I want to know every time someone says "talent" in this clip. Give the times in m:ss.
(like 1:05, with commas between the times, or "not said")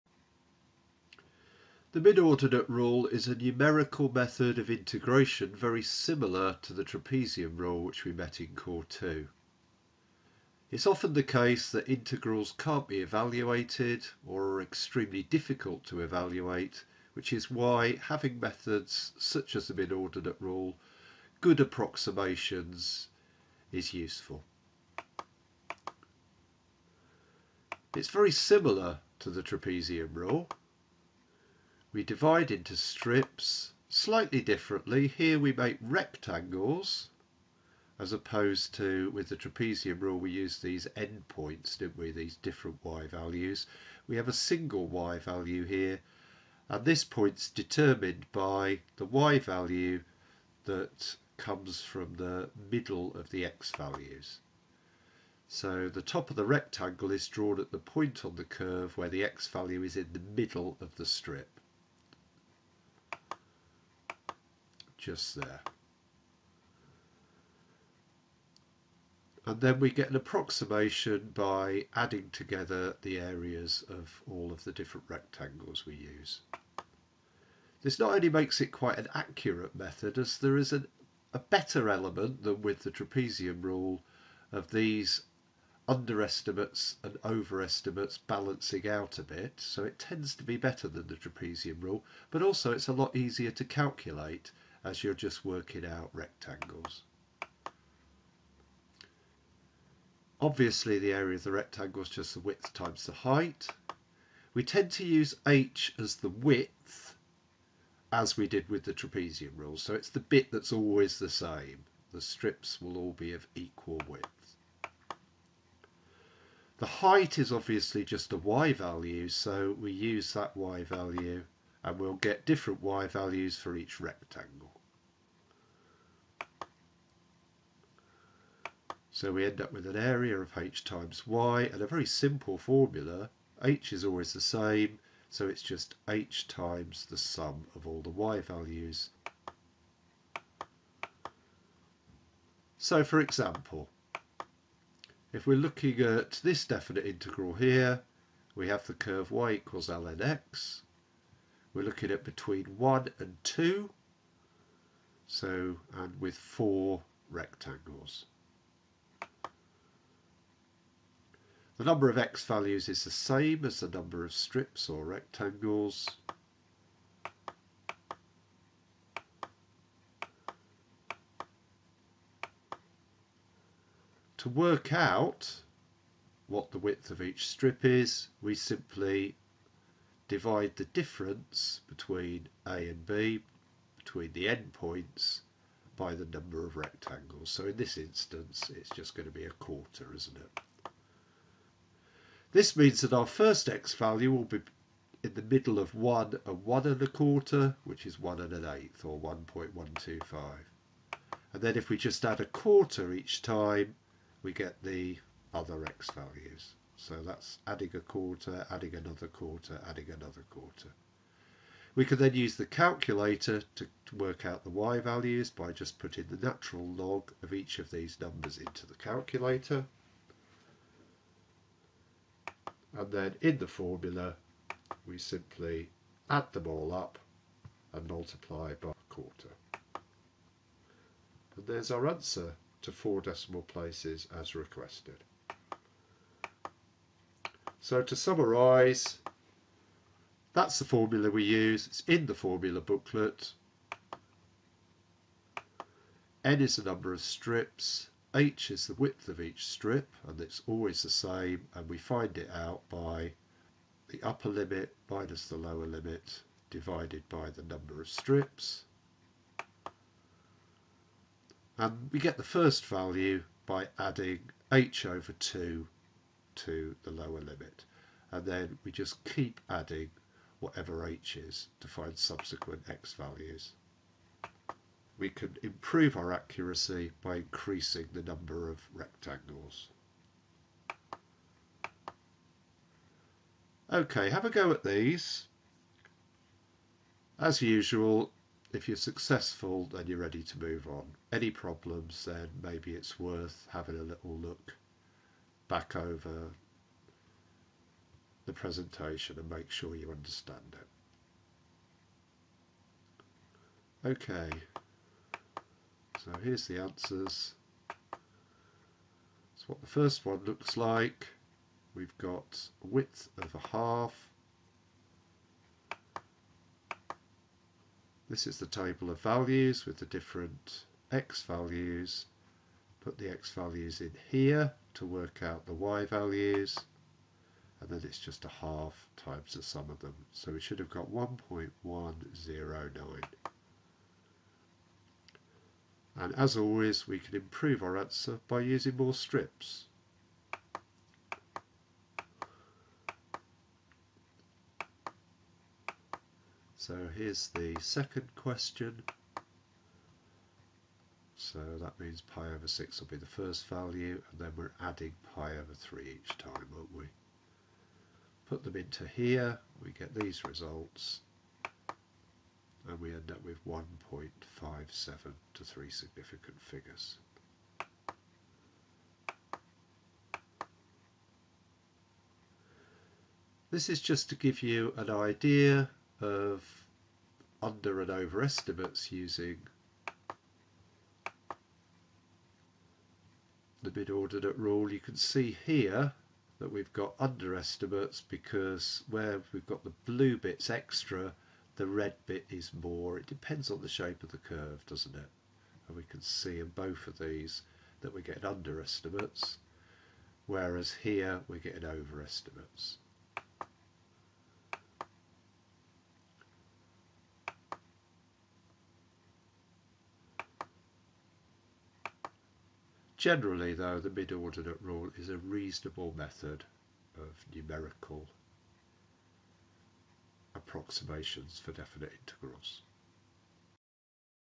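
not said.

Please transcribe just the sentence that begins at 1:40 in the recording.
Obviously the area of the rectangle is just the width times the height.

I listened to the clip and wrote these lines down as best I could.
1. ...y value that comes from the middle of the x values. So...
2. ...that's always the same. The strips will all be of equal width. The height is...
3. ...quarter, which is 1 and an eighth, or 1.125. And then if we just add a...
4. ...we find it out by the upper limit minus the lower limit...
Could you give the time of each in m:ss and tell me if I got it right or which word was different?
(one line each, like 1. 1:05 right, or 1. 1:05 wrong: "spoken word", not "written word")
1. 0:49 right
2. 1:50 right
3. 3:17 right
4. 4:11 right.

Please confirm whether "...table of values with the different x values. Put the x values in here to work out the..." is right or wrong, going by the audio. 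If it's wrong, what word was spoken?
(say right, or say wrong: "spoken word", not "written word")
right.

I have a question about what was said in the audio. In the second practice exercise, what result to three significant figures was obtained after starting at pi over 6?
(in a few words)
1.57.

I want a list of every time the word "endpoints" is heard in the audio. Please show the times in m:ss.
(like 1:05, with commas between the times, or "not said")
0:40, 3:04.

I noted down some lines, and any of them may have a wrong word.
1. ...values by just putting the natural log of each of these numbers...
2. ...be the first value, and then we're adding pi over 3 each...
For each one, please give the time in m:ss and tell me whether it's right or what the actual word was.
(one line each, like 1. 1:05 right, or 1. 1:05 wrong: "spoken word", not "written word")
1. 3:34 right
2. 5:53 right.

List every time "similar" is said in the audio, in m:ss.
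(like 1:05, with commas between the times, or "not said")
0:05, 0:28.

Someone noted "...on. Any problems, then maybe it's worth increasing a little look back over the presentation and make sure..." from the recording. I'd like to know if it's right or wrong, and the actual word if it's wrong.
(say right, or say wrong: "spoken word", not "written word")
wrong: "having", not "increasing".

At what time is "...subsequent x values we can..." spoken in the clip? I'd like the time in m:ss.
4:32.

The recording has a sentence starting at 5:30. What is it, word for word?
So we should have got 1.109.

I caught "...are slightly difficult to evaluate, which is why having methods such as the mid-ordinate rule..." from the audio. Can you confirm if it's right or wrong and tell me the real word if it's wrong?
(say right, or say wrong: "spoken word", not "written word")
wrong: "extremely", not "slightly".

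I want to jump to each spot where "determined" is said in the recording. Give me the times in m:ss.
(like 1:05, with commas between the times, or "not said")
0:47.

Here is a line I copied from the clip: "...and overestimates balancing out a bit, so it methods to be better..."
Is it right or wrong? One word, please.
wrong.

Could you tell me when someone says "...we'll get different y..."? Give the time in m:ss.
2:01.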